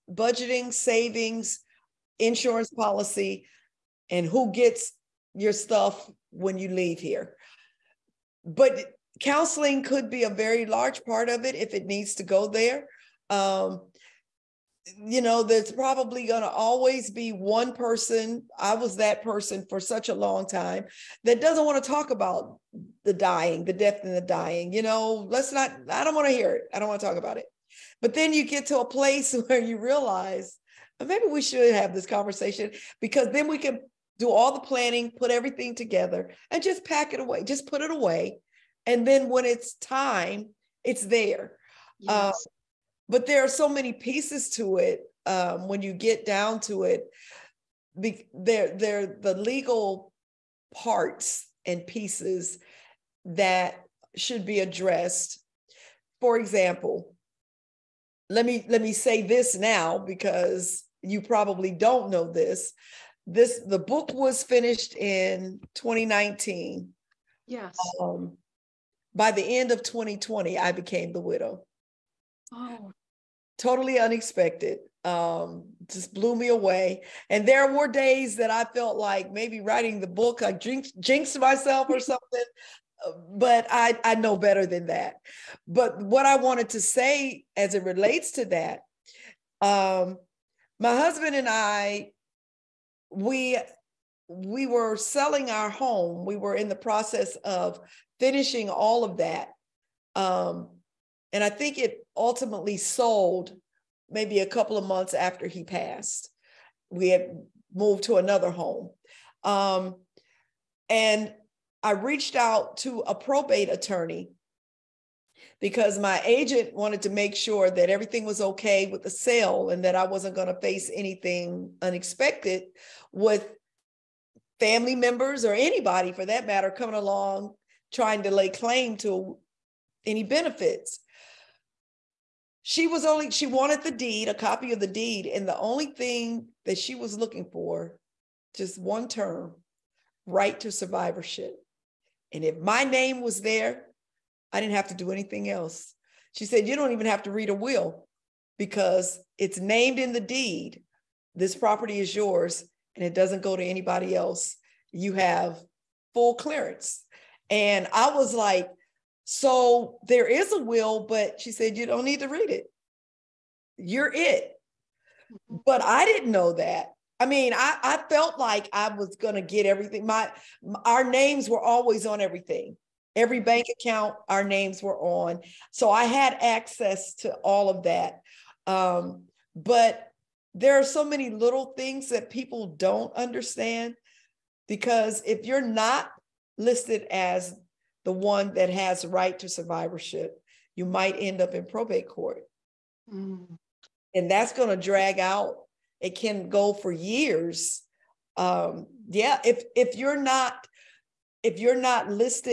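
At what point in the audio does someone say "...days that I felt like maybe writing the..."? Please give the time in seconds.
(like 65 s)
77 s.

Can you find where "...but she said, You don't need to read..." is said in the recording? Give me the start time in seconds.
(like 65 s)
161 s.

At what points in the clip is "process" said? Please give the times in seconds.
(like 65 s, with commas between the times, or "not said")
96 s.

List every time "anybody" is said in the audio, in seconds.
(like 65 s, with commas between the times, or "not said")
125 s, 153 s.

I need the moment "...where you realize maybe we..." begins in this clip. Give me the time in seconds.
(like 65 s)
29 s.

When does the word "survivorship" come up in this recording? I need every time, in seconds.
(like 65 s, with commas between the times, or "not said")
140 s, 189 s.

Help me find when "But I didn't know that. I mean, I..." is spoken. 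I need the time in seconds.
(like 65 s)
165 s.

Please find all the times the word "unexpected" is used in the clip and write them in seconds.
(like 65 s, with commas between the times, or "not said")
73 s, 121 s.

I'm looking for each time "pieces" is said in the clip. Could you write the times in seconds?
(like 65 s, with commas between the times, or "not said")
43 s, 51 s.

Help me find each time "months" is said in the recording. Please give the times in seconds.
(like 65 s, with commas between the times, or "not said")
104 s.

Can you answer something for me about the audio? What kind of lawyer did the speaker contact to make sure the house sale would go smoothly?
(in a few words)
Probate attorney.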